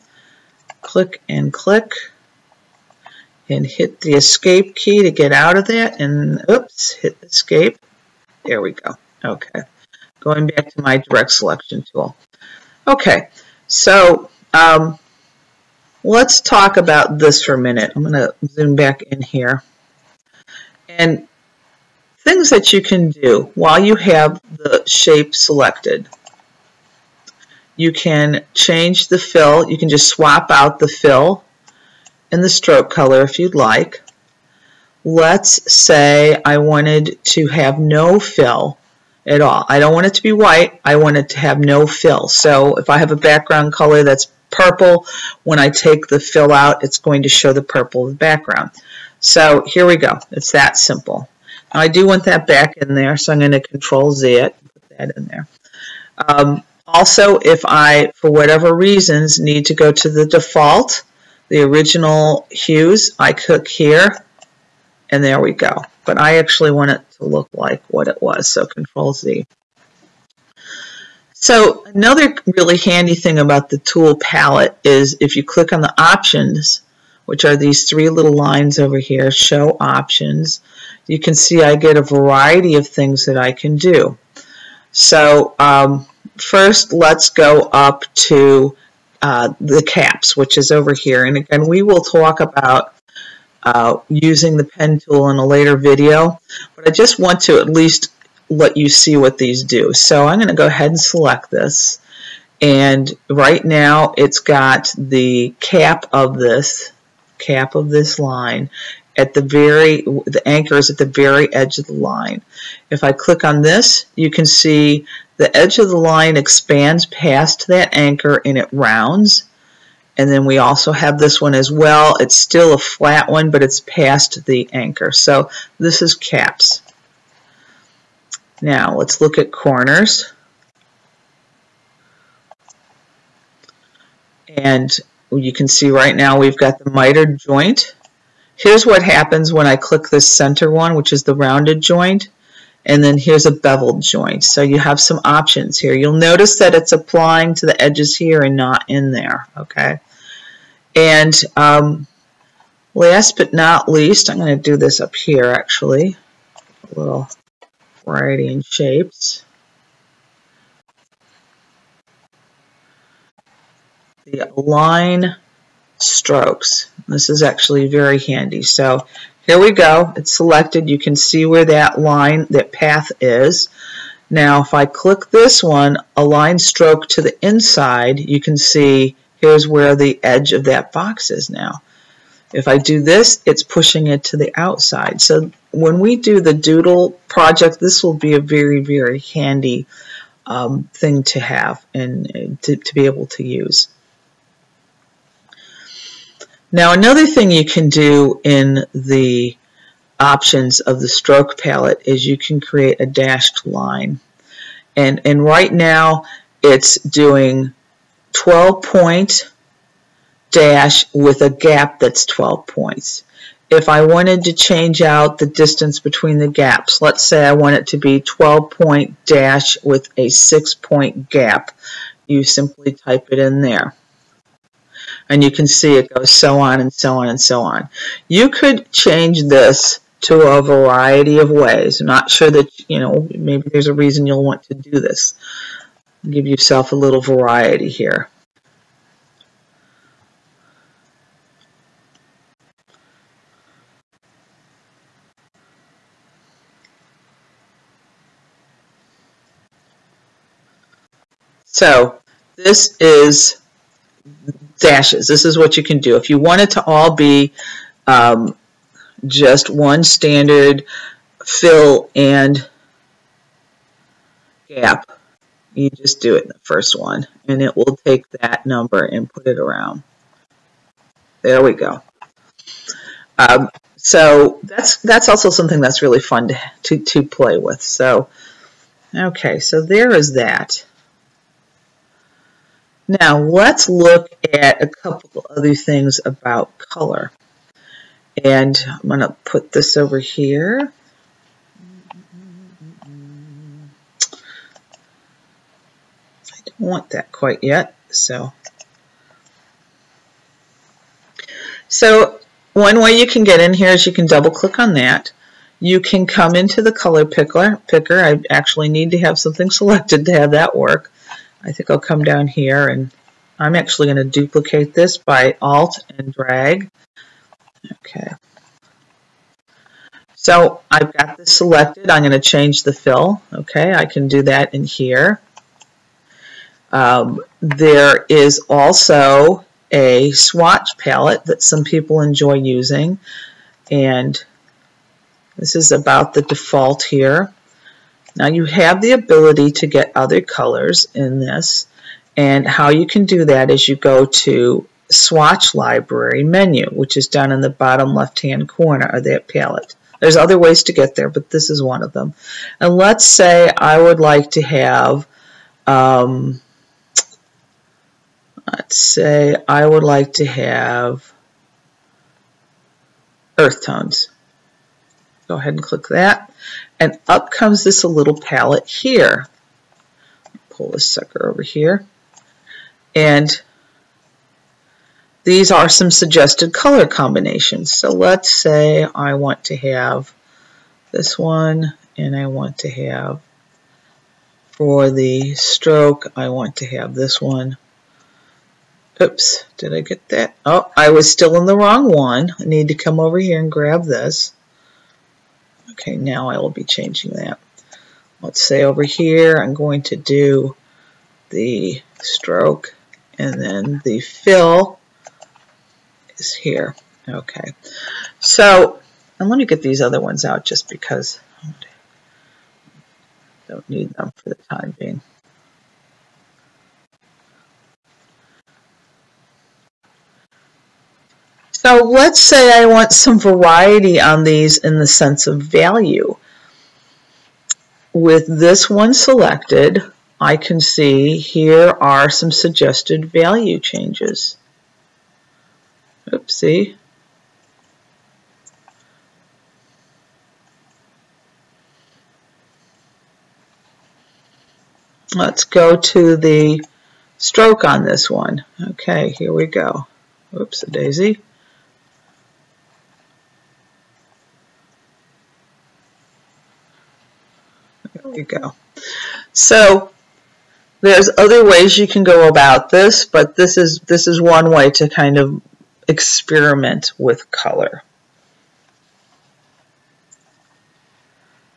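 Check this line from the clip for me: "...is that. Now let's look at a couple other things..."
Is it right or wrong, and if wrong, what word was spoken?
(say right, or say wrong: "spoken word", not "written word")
right.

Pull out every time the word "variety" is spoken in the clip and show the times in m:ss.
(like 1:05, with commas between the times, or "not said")
1:22, 2:38, 3:50, 3:57, 7:03.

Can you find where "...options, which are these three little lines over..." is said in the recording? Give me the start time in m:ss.
1:15.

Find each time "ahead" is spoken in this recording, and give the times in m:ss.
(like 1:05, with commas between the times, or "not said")
1:40, 6:05.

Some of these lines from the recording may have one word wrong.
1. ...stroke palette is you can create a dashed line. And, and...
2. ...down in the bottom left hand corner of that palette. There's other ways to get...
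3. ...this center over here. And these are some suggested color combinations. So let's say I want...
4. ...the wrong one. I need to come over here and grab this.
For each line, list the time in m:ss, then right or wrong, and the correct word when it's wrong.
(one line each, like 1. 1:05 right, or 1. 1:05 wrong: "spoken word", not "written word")
1. 3:21 right
2. 5:47 right
3. 6:10 wrong: "sucker", not "center"
4. 6:31 right.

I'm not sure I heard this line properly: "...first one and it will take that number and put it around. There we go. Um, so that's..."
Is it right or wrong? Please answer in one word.
right.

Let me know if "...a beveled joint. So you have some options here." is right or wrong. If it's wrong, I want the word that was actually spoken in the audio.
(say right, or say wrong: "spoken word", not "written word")
right.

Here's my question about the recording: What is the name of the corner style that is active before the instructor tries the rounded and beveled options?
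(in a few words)
Mitered joint.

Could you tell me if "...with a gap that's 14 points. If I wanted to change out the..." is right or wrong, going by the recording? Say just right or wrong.
wrong.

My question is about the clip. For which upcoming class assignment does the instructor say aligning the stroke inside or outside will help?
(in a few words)
The doodle project.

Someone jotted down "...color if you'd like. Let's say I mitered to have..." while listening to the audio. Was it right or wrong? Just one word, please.
wrong.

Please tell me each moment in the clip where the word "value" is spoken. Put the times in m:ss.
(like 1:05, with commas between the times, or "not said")
7:05, 7:13.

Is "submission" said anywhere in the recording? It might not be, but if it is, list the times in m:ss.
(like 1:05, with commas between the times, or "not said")
not said.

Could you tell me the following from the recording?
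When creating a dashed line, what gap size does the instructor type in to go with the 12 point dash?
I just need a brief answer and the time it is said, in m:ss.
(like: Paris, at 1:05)
6 points, at 3:40.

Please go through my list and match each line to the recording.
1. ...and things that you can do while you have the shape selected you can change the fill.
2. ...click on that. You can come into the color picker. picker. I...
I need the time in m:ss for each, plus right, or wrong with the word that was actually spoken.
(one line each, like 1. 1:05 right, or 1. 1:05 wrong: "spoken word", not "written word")
1. 0:20 right
2. 5:04 right.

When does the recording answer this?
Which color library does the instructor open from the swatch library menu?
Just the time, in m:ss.
6:03.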